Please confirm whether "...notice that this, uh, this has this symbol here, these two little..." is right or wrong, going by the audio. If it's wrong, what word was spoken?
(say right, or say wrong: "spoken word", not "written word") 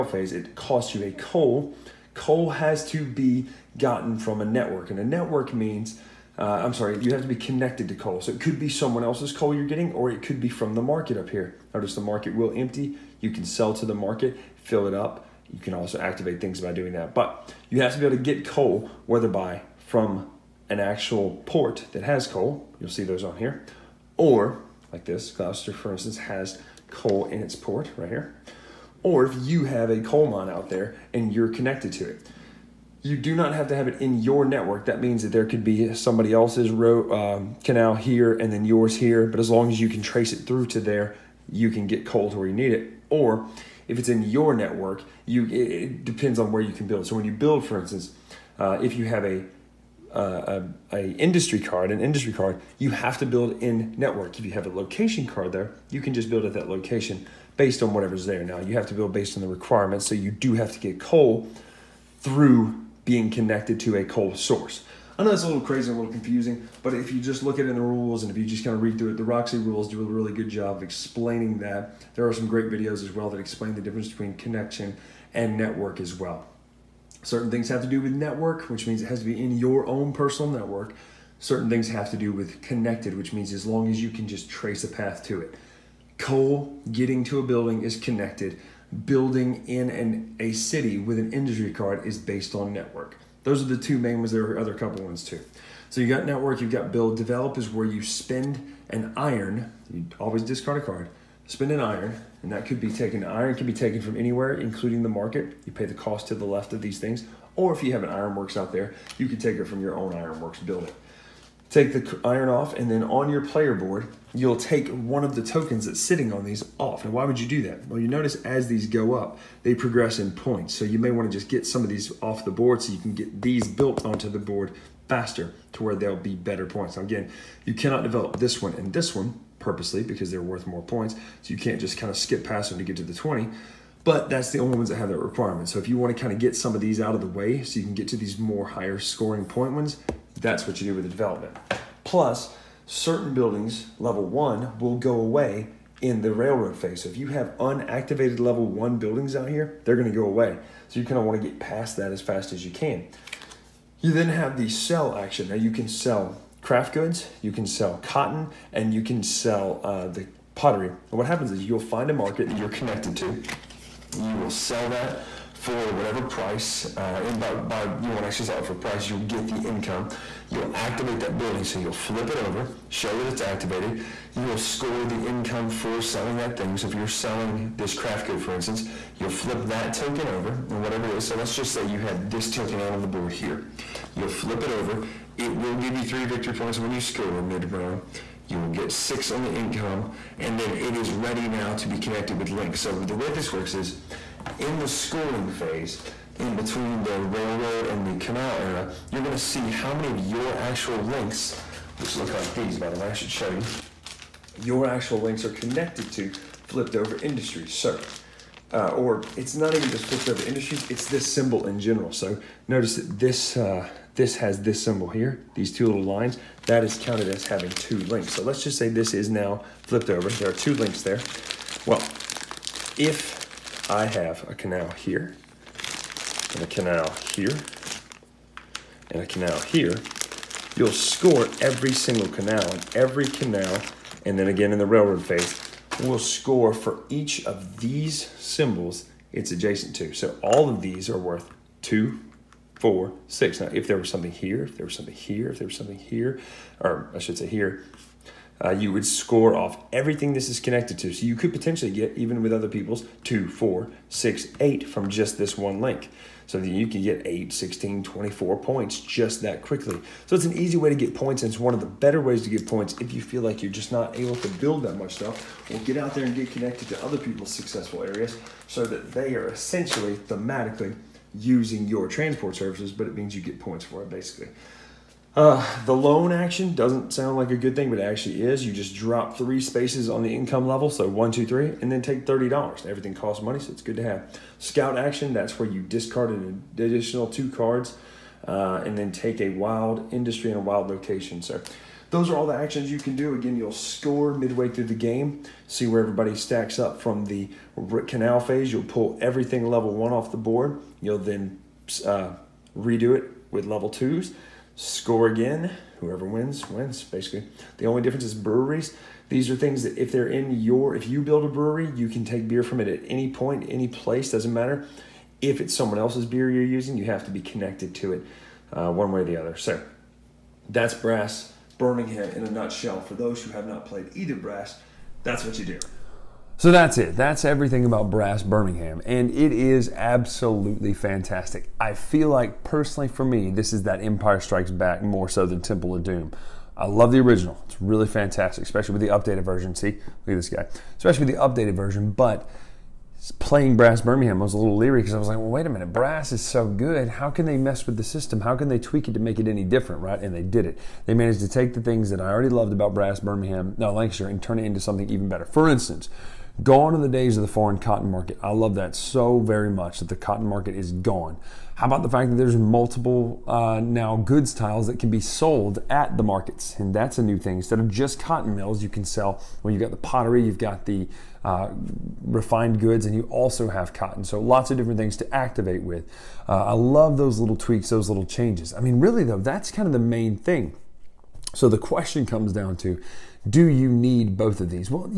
right.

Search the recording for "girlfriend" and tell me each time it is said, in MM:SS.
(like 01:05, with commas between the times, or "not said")
not said.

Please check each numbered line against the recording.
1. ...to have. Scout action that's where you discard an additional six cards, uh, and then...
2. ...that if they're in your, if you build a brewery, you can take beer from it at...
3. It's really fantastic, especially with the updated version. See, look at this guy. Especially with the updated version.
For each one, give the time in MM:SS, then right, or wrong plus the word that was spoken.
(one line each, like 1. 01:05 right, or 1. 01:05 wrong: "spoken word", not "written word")
1. 04:43 wrong: "two", not "six"
2. 05:09 right
3. 05:37 right.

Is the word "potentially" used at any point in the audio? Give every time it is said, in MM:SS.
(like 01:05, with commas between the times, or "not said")
04:11.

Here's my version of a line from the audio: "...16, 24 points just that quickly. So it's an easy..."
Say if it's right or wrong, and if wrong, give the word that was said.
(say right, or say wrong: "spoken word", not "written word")
right.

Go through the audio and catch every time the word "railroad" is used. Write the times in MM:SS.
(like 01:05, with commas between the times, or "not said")
02:26, 03:17, 03:54.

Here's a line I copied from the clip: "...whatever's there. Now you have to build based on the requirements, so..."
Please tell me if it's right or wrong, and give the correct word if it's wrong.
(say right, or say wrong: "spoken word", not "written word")
right.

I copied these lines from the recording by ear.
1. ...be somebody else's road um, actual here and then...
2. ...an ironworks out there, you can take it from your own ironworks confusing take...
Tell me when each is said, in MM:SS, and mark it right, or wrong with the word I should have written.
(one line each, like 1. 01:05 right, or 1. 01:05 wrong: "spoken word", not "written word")
1. 00:35 wrong: "canal", not "actual"
2. 01:48 wrong: "building", not "confusing".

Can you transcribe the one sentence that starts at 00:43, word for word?
Or if it's in your network, you it, depends on where you can build.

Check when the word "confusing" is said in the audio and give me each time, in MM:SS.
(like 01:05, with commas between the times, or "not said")
01:06.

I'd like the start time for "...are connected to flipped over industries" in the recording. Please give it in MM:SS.
03:25.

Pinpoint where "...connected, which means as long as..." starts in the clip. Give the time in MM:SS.
01:22.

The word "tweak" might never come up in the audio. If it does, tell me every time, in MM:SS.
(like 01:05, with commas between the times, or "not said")
05:48, 06:17.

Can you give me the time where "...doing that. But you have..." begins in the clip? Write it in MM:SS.
00:16.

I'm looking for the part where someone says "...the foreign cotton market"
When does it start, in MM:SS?
05:57.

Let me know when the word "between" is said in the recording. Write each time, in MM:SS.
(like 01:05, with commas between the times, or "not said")
01:14, 03:16.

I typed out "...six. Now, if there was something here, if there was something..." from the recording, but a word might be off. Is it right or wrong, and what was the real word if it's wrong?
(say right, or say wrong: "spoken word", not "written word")
right.